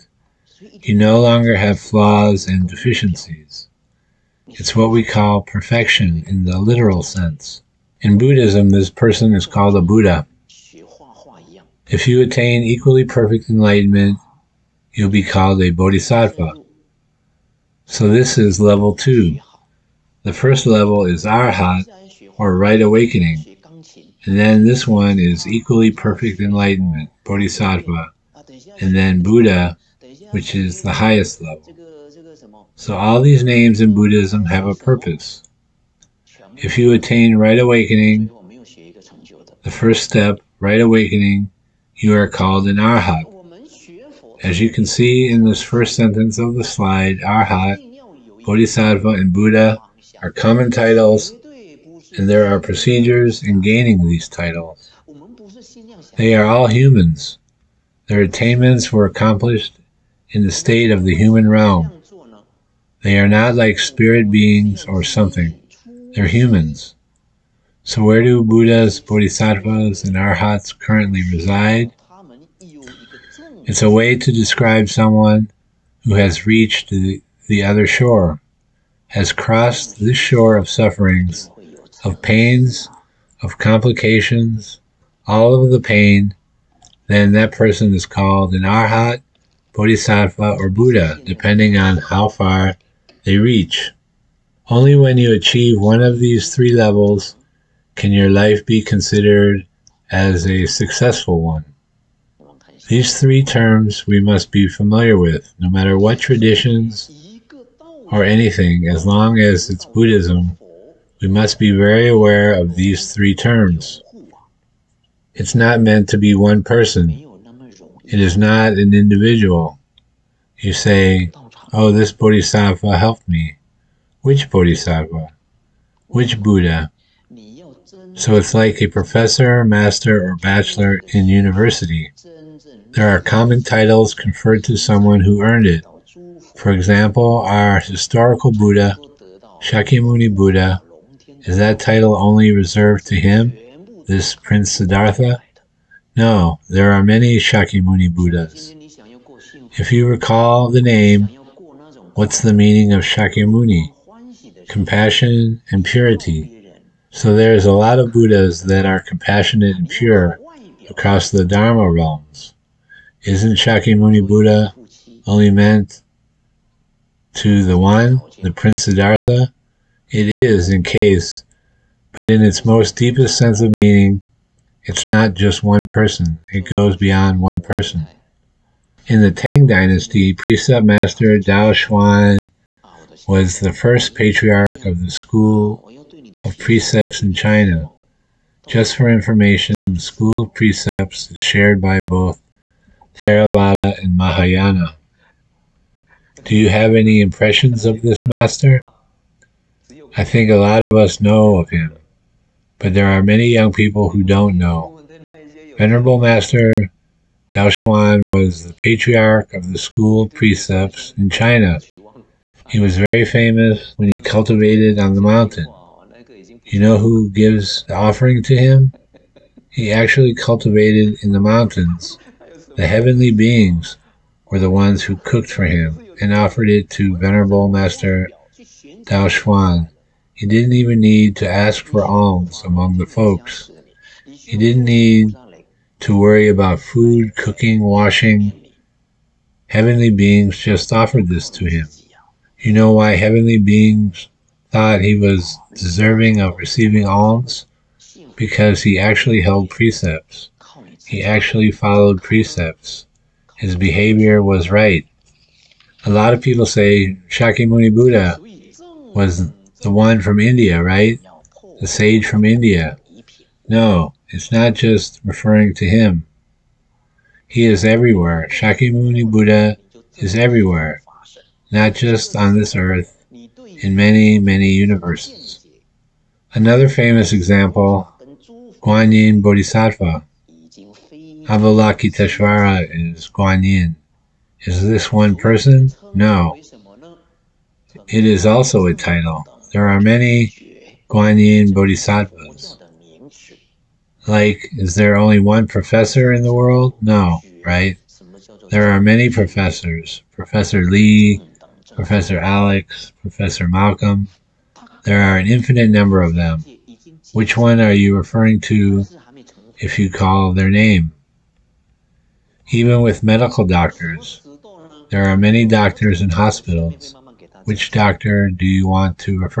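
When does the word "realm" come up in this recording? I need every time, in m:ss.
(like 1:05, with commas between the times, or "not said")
1:01, 2:41.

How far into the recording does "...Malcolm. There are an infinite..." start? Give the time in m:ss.
5:03.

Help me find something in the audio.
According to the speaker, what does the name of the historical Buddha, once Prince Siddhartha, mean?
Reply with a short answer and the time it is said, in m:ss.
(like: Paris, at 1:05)
Compassion and purity, at 2:34.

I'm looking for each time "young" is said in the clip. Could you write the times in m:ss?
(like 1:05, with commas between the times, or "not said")
3:23.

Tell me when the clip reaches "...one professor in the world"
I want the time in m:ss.
4:55.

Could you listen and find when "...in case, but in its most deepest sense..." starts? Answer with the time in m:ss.
2:50.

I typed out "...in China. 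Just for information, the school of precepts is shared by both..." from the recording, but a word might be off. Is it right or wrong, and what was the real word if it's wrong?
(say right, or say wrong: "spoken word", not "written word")
right.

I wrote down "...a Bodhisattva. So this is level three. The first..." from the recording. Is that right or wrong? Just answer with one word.
wrong.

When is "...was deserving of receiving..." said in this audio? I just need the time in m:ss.
4:05.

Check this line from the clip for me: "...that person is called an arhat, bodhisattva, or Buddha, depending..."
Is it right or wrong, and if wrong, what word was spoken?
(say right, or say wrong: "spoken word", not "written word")
right.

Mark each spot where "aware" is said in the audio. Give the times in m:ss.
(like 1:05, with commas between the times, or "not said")
1:52.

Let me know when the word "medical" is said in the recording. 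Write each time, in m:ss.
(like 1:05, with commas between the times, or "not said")
5:13.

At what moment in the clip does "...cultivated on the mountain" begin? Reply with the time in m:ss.
3:34.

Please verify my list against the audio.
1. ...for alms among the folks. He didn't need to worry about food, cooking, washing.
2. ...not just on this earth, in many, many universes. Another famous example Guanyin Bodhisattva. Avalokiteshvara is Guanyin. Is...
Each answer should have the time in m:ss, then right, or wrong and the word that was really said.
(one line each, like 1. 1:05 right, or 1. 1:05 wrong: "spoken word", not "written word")
1. 3:51 right
2. 4:31 right.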